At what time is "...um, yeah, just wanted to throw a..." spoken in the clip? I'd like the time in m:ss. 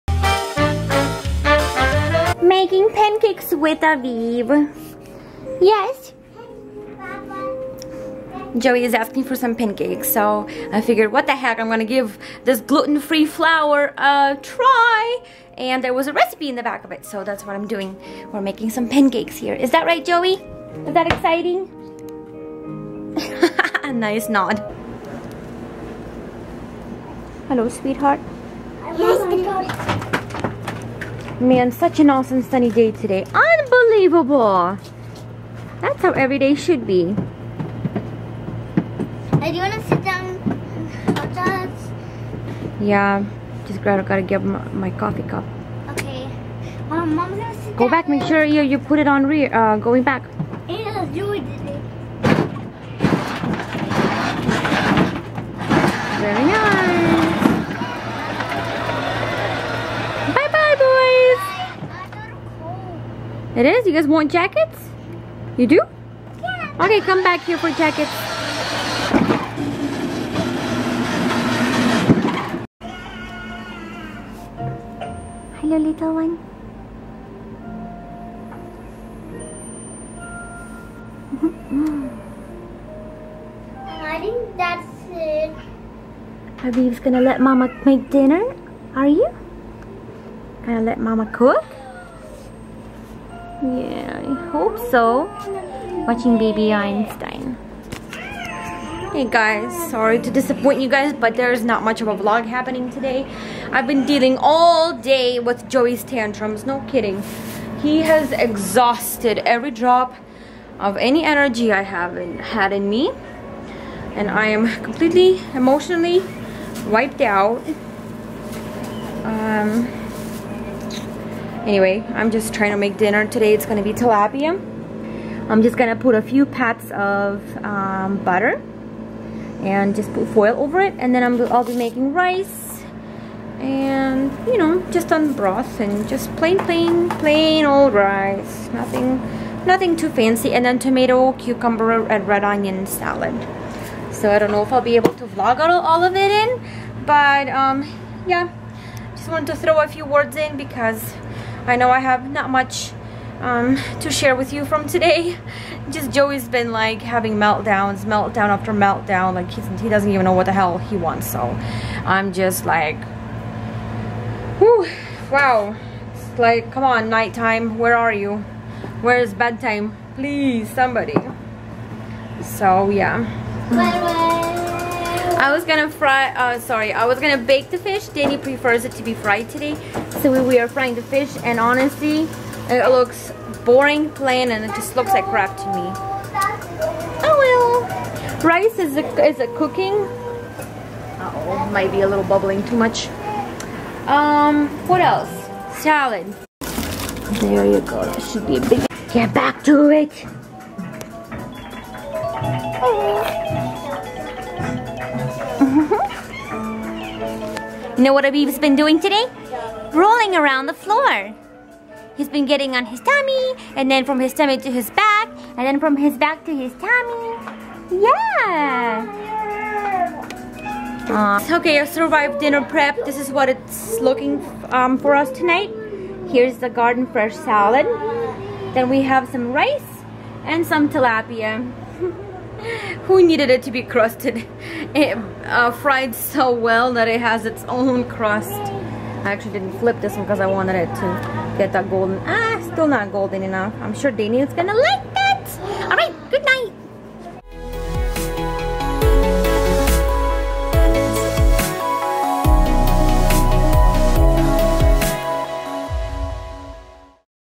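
2:27.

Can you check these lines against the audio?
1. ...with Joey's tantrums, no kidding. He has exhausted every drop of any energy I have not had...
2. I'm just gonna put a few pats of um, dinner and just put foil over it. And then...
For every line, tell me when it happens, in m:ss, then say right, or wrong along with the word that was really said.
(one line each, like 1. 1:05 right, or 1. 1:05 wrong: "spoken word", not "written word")
1. 1:45 right
2. 2:05 wrong: "butter", not "dinner".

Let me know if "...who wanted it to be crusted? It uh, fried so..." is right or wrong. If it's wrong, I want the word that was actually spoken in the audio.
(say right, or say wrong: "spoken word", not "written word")
wrong: "needed", not "wanted".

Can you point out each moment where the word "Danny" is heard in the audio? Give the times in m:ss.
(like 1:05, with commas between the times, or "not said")
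2:58, 4:04.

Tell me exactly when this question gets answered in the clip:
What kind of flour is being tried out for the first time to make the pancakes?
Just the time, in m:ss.
0:12.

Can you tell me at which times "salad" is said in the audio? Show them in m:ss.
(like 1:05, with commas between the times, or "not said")
2:22, 3:15, 3:47.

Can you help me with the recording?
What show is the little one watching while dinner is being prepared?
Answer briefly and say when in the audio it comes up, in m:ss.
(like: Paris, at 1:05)
Baby Einstein, at 1:36.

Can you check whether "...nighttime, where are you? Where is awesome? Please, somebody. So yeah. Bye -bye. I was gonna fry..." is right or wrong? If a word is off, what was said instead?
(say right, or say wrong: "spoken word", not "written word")
wrong: "bedtime", not "awesome".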